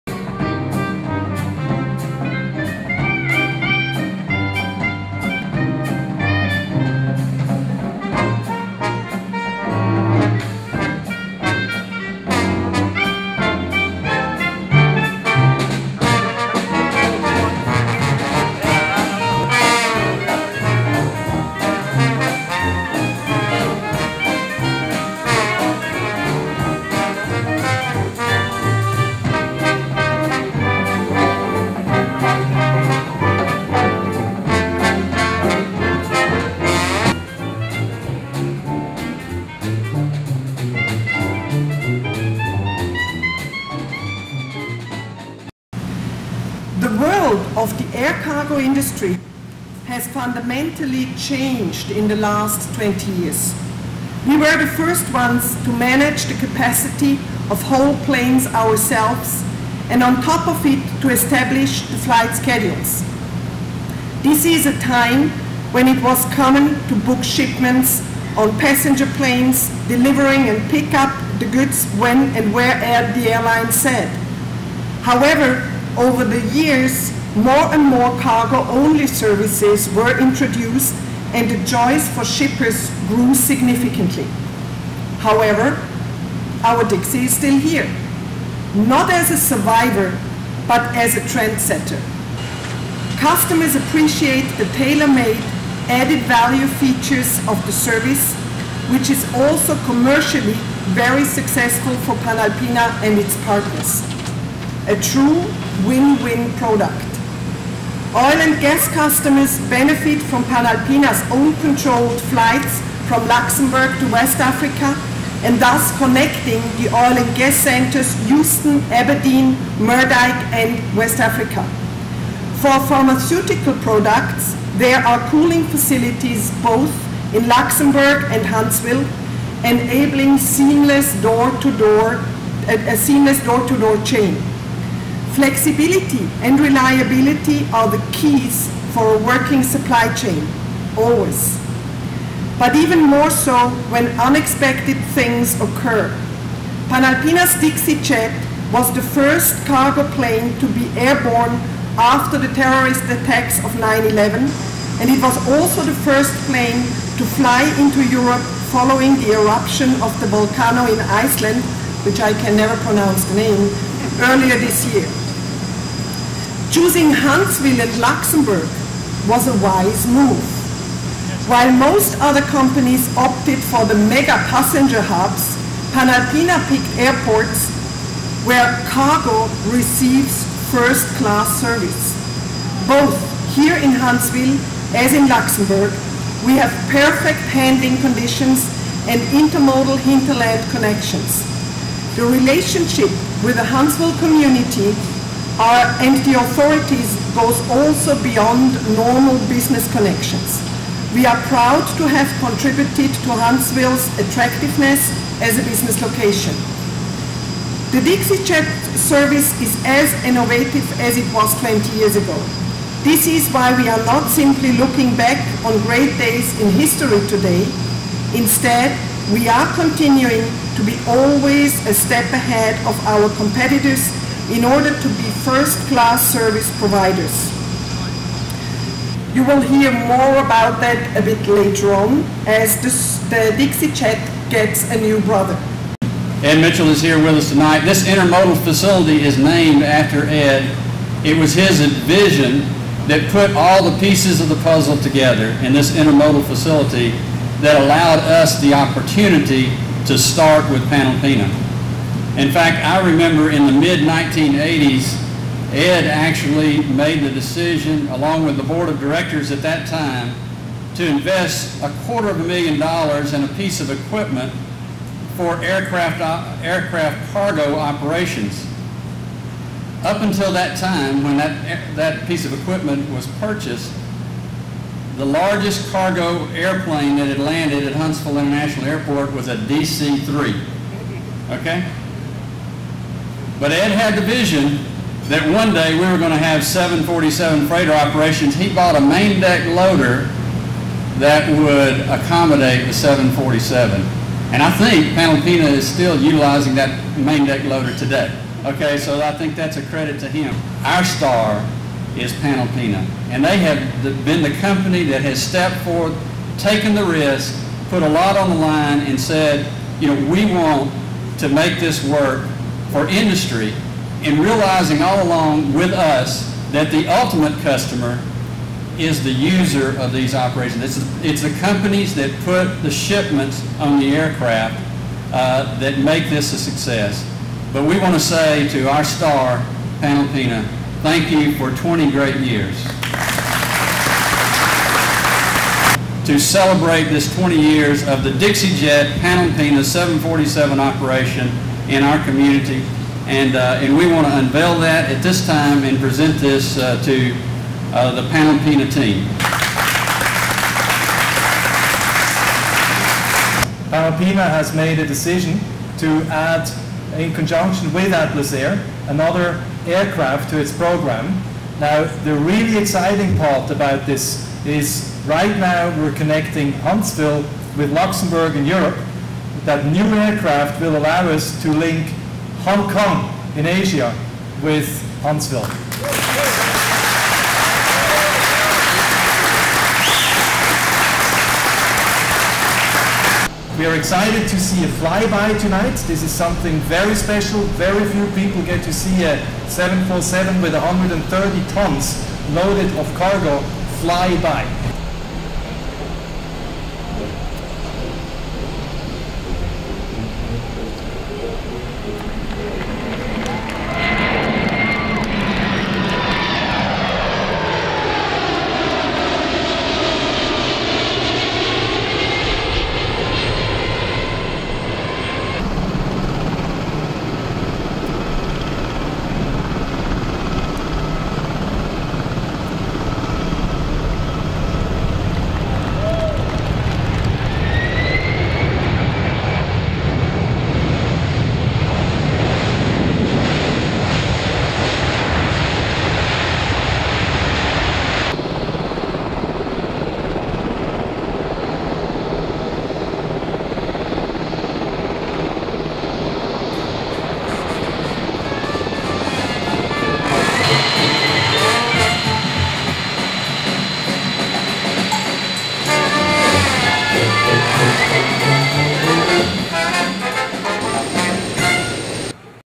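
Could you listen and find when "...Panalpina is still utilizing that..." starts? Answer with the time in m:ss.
4:55.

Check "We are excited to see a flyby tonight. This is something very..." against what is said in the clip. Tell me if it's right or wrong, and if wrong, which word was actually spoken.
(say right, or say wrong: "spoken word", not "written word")
right.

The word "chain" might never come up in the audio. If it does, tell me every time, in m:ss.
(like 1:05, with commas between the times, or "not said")
2:14, 2:20.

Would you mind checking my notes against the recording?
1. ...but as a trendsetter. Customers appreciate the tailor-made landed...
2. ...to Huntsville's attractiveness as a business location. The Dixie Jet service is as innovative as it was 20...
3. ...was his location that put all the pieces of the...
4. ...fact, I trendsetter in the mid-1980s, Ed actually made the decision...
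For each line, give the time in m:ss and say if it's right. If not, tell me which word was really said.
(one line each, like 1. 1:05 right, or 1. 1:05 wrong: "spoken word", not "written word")
1. 1:30 wrong: "added", not "landed"
2. 3:23 right
3. 4:01 wrong: "vision", not "location"
4. 4:12 wrong: "remember", not "trendsetter".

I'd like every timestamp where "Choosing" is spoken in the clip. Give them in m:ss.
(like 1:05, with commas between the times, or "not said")
2:46.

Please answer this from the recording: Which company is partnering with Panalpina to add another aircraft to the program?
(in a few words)
Atlas Air.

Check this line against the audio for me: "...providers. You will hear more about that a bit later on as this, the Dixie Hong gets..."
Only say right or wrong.
wrong.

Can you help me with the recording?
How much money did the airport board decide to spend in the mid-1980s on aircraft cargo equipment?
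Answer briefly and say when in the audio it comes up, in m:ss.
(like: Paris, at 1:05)
A quarter of a million dollars, at 4:21.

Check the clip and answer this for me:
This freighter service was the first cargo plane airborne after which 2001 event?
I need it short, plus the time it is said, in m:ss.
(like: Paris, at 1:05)
9-11, at 2:33.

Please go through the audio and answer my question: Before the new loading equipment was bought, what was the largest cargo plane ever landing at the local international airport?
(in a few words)
DC-3.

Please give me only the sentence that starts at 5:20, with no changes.
It's, it's the companies that put the shipments on the aircraft uh, that make this a success.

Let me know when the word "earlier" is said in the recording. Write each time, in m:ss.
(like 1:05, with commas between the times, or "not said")
2:44.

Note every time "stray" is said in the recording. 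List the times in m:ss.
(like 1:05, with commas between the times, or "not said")
not said.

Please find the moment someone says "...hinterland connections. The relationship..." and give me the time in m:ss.
3:09.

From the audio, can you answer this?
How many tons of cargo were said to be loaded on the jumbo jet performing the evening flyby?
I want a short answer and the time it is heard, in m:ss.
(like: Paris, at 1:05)
130, at 6:30.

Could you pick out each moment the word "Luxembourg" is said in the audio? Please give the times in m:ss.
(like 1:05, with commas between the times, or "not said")
1:53, 2:07, 2:47, 3:05, 6:07.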